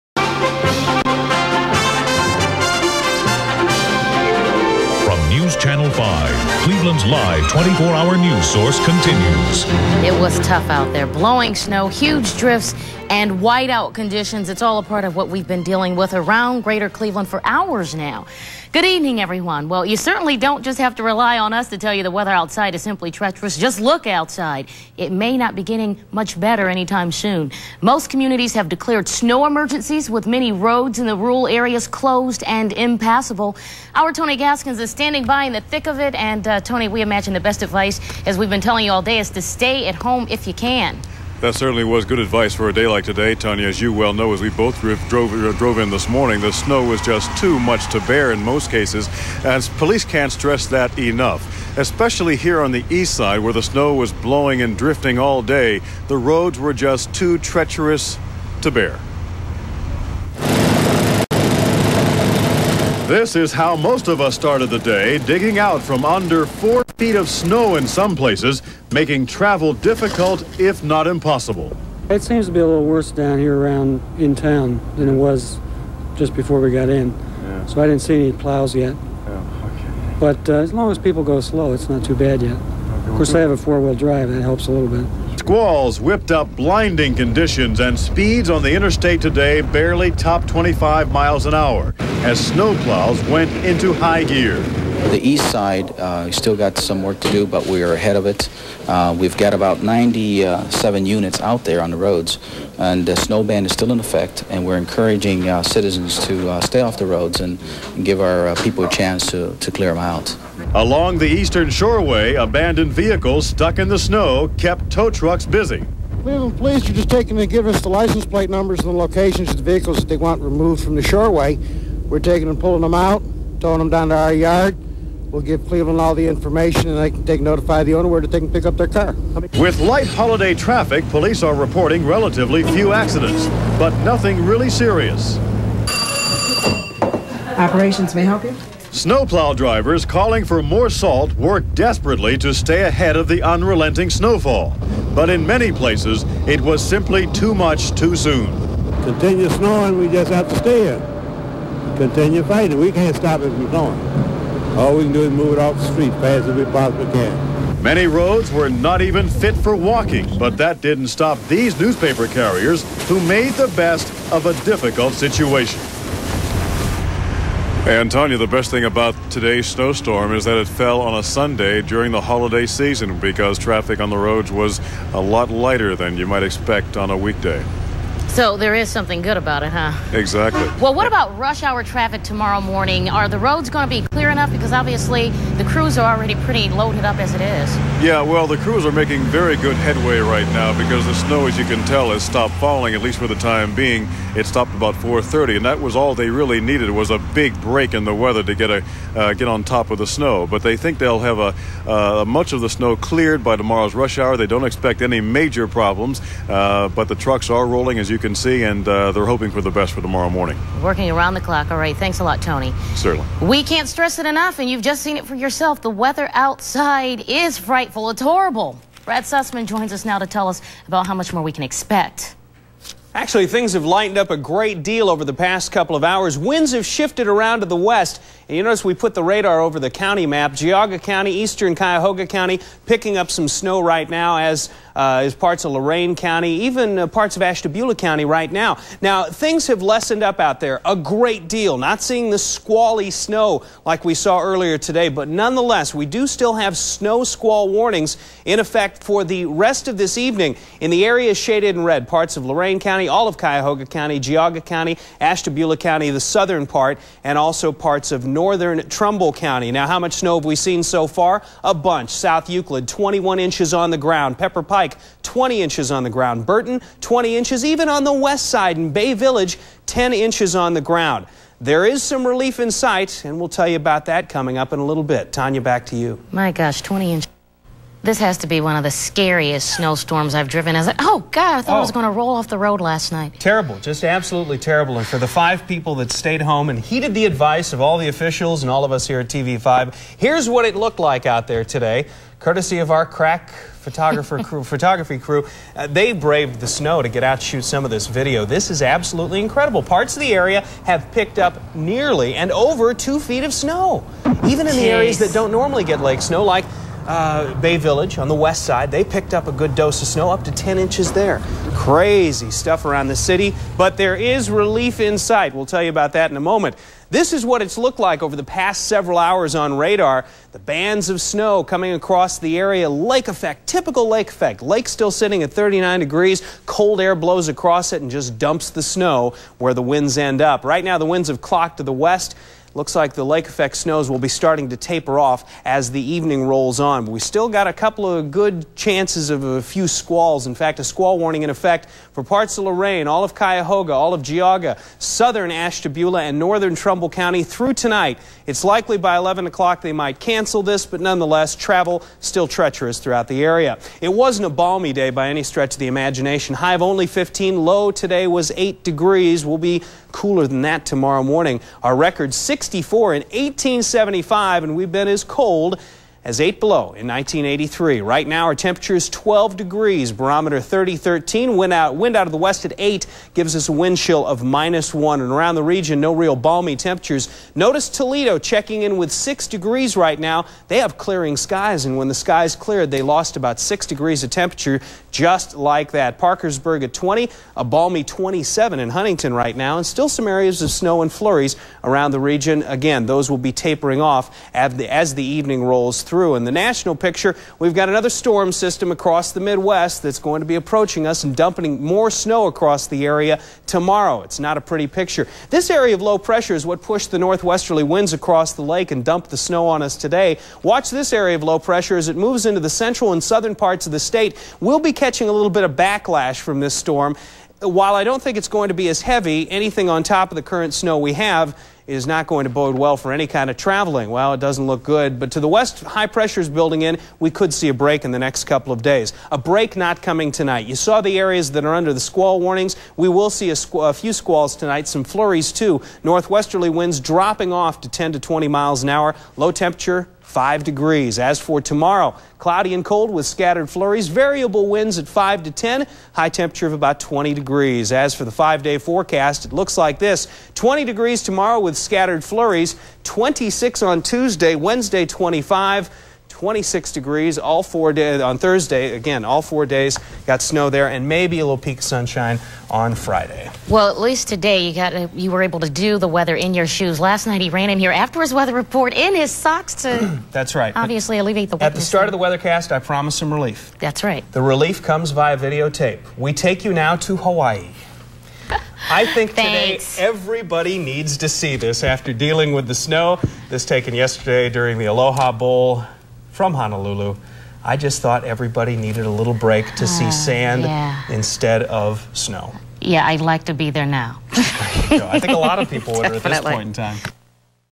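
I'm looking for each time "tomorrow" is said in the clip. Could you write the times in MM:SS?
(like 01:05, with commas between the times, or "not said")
03:02, 03:23, 03:30, 06:00, 06:43, 07:21, 07:31.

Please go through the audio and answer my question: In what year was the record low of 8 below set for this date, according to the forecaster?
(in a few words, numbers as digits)
1983.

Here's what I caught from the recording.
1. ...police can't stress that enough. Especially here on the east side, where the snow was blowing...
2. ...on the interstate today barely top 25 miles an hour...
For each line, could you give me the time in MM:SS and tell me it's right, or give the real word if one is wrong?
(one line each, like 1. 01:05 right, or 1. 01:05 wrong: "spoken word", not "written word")
1. 00:49 right
2. 01:28 right.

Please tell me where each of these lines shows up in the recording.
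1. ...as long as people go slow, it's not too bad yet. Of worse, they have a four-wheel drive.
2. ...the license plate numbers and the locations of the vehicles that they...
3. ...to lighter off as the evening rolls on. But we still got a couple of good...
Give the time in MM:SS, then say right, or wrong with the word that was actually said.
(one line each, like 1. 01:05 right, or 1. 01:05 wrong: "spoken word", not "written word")
1. 01:20 wrong: "course", not "worse"
2. 01:57 right
3. 05:34 wrong: "taper", not "lighter".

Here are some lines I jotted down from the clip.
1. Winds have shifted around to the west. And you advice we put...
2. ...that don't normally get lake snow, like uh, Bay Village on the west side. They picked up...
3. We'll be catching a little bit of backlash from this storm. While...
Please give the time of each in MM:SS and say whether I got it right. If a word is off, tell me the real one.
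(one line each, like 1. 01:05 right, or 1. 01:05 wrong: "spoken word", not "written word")
1. 03:46 wrong: "notice", not "advice"
2. 05:05 right
3. 06:54 right.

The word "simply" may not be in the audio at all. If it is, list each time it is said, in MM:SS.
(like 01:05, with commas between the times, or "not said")
00:22, 02:26.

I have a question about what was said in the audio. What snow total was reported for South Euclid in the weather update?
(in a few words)
21 inches.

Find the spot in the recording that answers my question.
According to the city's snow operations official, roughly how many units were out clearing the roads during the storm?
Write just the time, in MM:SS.
01:39.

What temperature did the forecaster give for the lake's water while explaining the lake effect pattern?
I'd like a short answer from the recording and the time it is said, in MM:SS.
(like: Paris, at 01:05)
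39 degrees, at 05:25.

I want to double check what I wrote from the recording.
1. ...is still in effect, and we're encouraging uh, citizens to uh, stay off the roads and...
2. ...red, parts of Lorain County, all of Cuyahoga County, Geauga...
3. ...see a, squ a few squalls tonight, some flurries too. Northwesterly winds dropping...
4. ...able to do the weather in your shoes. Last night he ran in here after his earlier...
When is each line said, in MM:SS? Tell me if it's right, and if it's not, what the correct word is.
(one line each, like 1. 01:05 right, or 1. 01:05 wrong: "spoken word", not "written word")
1. 01:43 right
2. 04:11 right
3. 07:13 right
4. 07:45 wrong: "weather", not "earlier".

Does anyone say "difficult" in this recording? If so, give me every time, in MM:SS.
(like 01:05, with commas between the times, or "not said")
01:09, 02:44.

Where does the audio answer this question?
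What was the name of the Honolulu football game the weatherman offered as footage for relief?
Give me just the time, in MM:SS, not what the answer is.
08:04.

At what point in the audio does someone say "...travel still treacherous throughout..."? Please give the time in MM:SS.
05:51.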